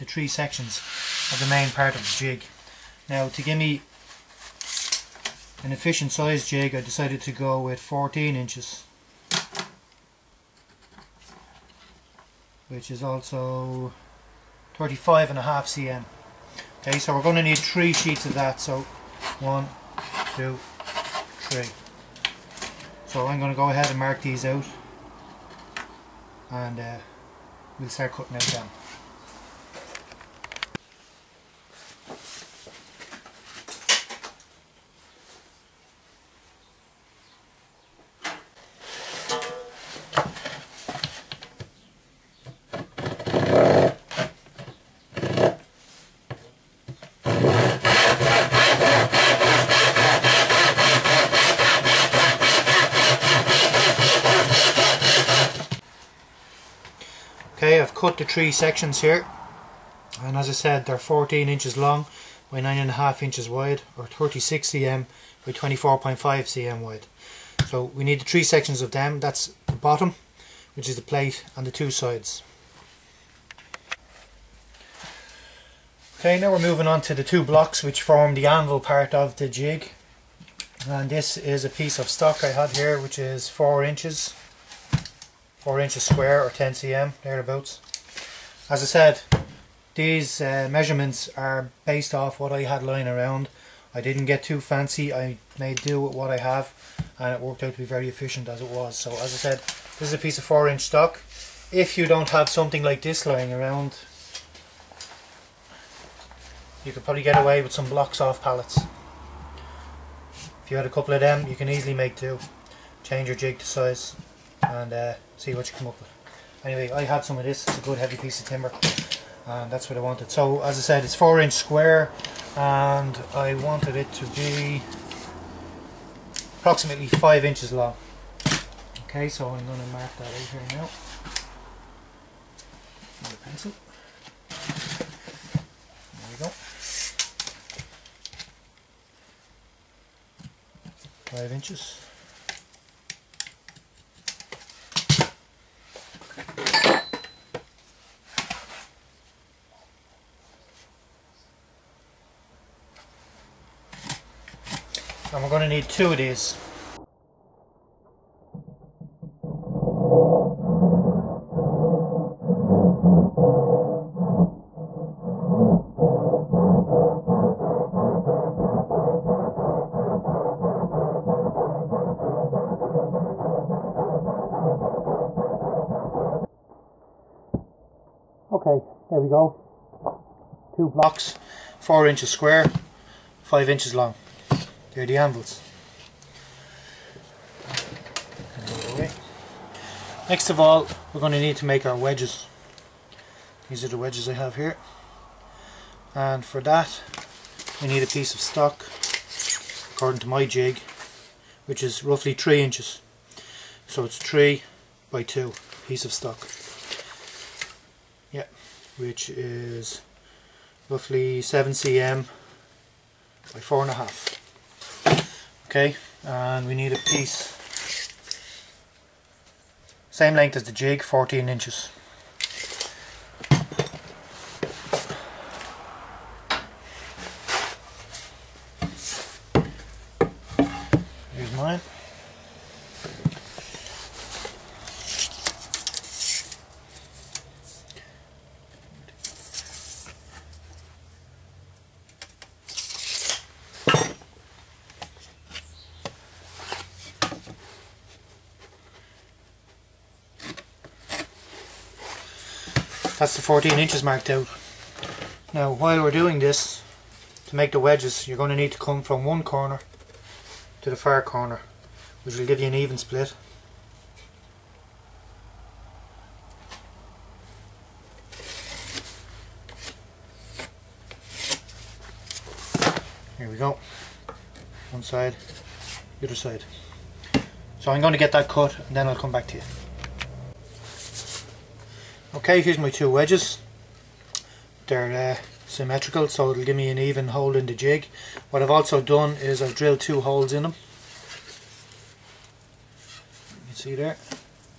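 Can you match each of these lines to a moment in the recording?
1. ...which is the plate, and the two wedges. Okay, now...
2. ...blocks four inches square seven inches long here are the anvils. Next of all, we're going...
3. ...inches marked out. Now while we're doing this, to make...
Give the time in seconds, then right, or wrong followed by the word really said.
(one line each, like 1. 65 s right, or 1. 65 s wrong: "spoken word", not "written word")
1. 70 s wrong: "sides", not "wedges"
2. 180 s wrong: "five", not "seven"
3. 253 s right.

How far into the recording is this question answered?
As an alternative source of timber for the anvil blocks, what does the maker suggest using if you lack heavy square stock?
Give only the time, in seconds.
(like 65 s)
108 s.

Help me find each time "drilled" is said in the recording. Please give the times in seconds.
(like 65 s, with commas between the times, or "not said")
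289 s.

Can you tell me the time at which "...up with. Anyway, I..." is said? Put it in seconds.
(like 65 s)
115 s.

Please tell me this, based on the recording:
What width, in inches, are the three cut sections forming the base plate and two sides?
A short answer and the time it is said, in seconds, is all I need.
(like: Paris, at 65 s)
9.5 inches, at 62 s.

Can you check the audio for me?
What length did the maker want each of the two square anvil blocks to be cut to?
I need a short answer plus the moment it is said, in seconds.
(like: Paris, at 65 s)
5 inches, at 126 s.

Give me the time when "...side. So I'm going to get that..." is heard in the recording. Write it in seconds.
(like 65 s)
276 s.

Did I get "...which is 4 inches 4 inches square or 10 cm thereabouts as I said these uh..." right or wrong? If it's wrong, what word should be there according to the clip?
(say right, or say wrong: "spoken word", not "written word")
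right.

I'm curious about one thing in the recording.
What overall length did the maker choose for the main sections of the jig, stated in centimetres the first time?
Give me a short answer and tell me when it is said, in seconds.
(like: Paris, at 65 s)
35.5 cm, at 14 s.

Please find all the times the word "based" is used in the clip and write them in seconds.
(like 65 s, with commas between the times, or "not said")
91 s.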